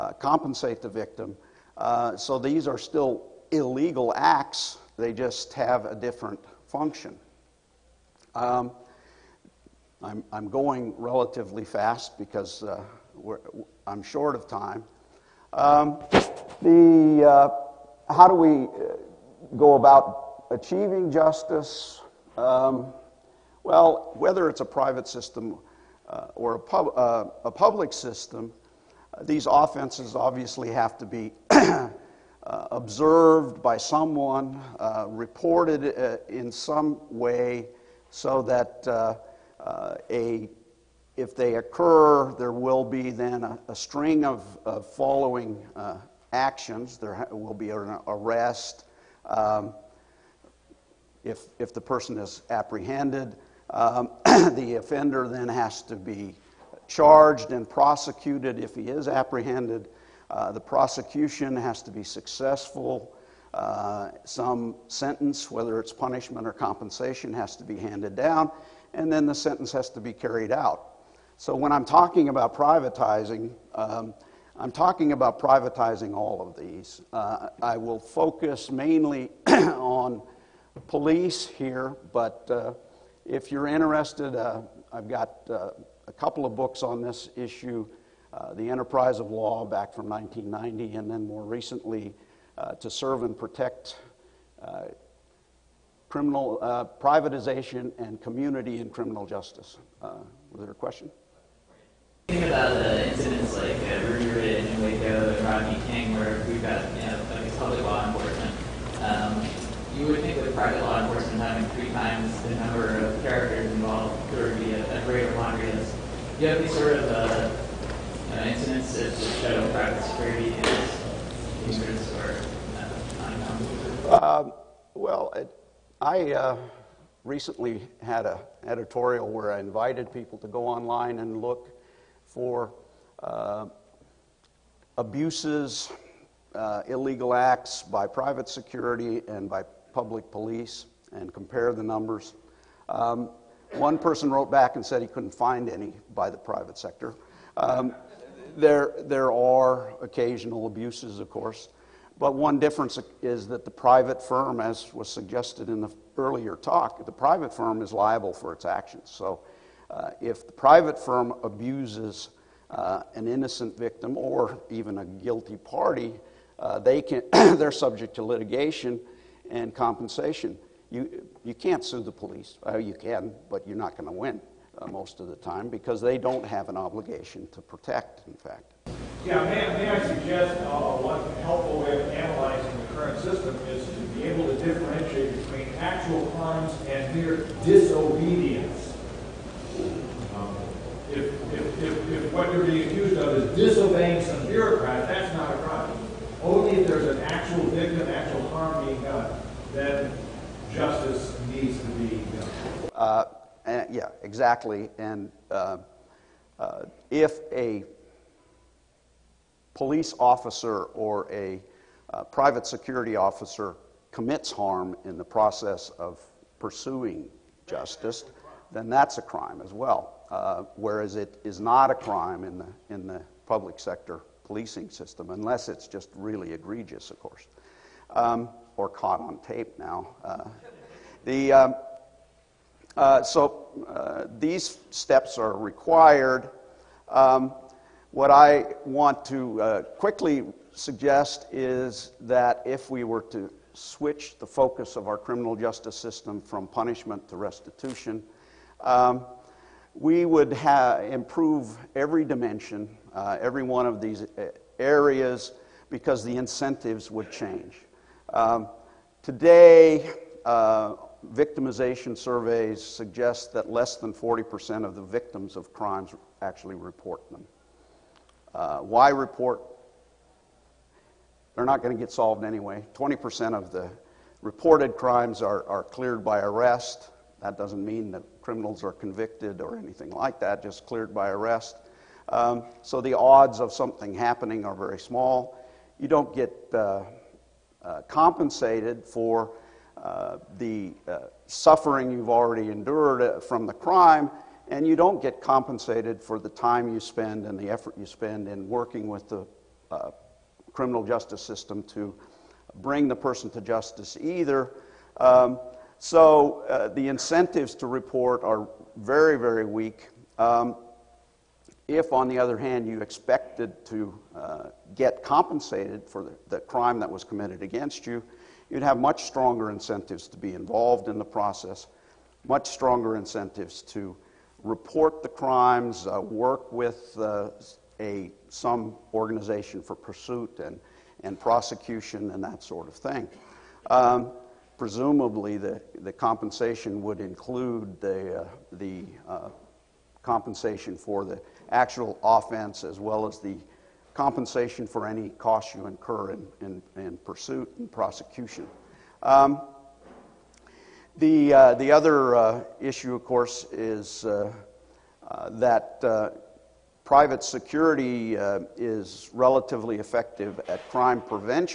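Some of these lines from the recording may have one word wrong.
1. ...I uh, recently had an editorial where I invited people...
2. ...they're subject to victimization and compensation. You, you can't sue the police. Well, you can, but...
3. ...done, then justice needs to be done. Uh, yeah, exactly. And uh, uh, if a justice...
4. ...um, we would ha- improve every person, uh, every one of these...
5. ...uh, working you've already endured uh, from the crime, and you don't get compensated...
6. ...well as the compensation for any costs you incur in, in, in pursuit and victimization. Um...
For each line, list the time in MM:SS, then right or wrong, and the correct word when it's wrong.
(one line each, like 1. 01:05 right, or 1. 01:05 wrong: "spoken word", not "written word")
1. 02:06 right
2. 02:47 wrong: "litigation", not "victimization"
3. 03:19 wrong: "police", not "justice"
4. 04:08 wrong: "dimension", not "person"
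5. 04:51 wrong: "suffering", not "working"
6. 05:42 wrong: "prosecution", not "victimization".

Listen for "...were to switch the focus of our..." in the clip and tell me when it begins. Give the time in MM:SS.
04:03.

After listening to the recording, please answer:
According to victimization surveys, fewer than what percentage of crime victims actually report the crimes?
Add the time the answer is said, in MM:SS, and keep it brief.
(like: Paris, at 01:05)
40%, at 04:24.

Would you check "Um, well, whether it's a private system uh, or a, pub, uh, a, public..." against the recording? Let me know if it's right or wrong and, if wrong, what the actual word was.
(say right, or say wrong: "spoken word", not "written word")
right.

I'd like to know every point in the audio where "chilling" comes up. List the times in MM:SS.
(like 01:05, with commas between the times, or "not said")
not said.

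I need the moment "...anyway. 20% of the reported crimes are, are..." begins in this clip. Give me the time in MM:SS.
04:32.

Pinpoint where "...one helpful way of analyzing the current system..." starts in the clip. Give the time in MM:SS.
03:00.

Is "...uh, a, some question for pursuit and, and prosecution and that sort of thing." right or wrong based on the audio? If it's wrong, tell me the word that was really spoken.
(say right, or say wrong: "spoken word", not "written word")
wrong: "organization", not "question".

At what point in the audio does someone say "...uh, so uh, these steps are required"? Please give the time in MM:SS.
03:52.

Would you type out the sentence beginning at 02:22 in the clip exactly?
Um, one person wrote back and said he couldn't find any by the private sector.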